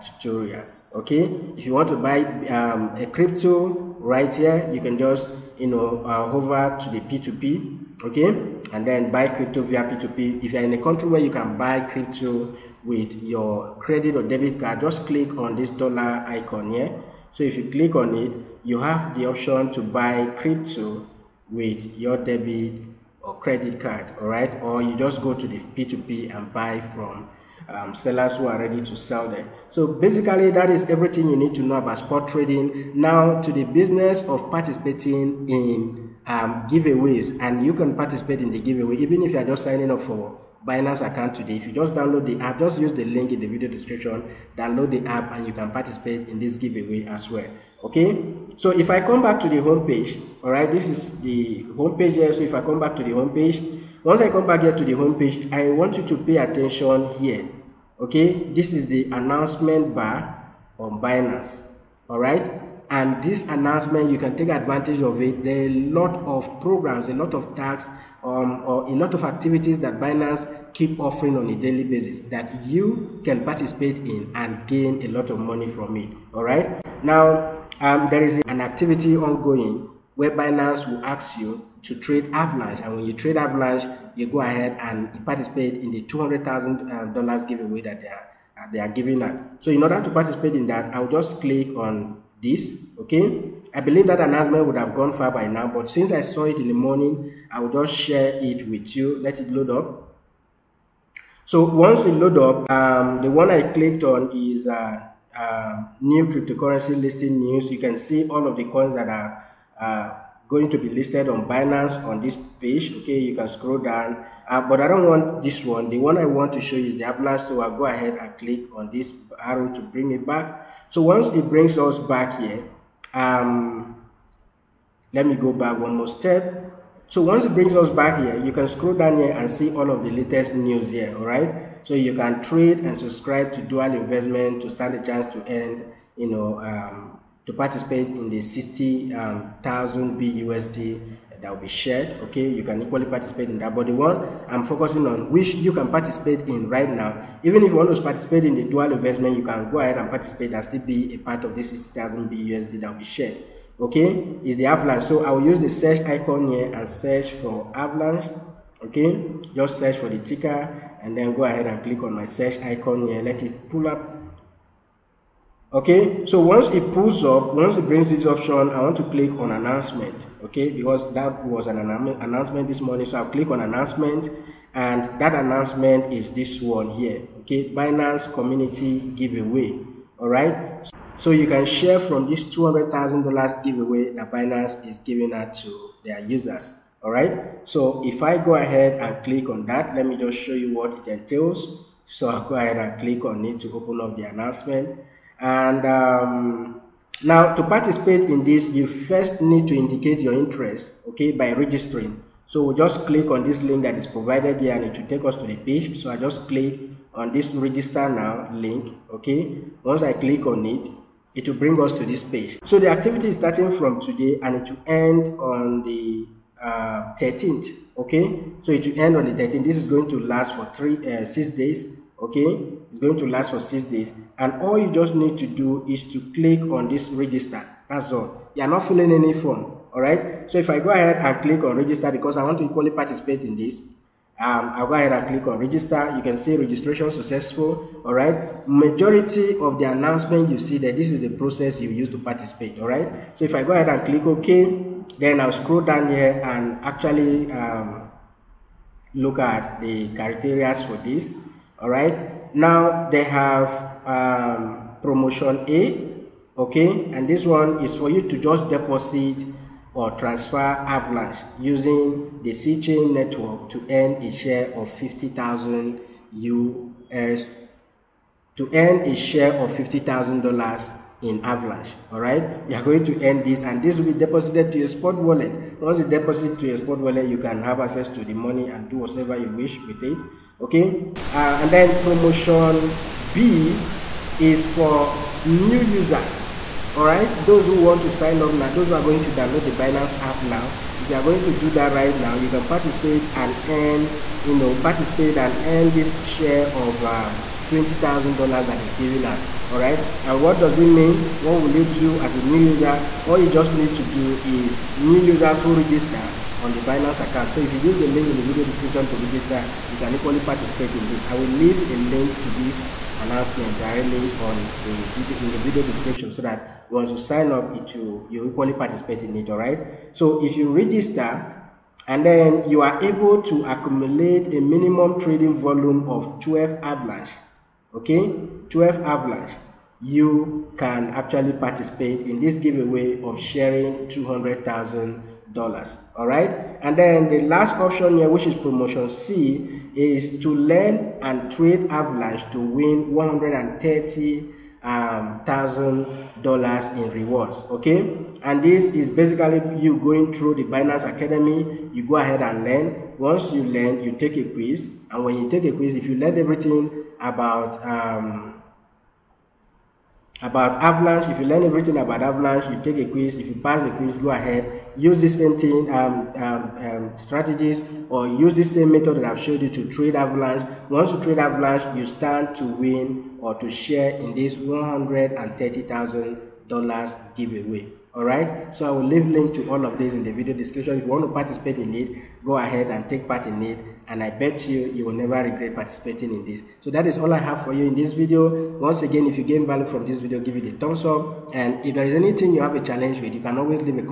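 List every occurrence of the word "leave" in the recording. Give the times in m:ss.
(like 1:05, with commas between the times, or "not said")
5:11, 6:19.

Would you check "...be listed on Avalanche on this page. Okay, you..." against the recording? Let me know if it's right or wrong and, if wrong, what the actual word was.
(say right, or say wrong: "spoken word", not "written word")
wrong: "Binance", not "Avalanche".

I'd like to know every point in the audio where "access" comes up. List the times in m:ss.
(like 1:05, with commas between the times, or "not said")
4:37.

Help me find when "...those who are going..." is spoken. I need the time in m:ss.
4:48.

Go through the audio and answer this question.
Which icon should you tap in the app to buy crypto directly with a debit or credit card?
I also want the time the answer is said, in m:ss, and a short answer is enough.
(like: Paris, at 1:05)
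dollar icon, at 0:15.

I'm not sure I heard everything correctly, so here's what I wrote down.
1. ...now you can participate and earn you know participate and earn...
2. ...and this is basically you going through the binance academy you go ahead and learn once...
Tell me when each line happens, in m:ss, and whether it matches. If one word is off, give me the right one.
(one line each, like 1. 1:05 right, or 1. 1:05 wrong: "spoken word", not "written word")
1. 4:52 right
2. 5:48 right.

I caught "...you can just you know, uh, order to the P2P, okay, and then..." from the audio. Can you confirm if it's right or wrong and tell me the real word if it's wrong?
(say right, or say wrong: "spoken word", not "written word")
wrong: "hover", not "order".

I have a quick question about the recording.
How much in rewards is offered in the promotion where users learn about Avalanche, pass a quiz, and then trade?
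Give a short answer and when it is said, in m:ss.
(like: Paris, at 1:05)
$130,000, at 5:43.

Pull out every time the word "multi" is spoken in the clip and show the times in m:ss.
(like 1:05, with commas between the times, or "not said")
not said.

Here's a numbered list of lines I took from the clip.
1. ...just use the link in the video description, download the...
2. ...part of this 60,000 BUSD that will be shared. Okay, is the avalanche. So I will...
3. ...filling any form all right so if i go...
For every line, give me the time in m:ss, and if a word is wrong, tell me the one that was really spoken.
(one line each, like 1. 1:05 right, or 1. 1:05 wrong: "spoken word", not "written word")
1. 0:42 right
2. 2:31 right
3. 3:48 right.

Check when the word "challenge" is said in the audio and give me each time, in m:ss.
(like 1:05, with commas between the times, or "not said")
6:32.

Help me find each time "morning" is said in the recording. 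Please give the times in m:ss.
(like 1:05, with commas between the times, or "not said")
1:36, 2:52.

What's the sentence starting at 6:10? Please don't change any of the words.
Once you trade avalanche, you stand to win or to share in this $130,000 giveaway.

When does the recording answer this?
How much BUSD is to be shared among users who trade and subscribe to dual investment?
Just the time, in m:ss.
2:18.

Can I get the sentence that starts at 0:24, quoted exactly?
Or you just go to the P2P and buy from um, sellers who are ready to sell there.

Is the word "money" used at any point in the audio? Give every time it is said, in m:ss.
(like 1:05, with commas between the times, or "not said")
1:15, 4:38.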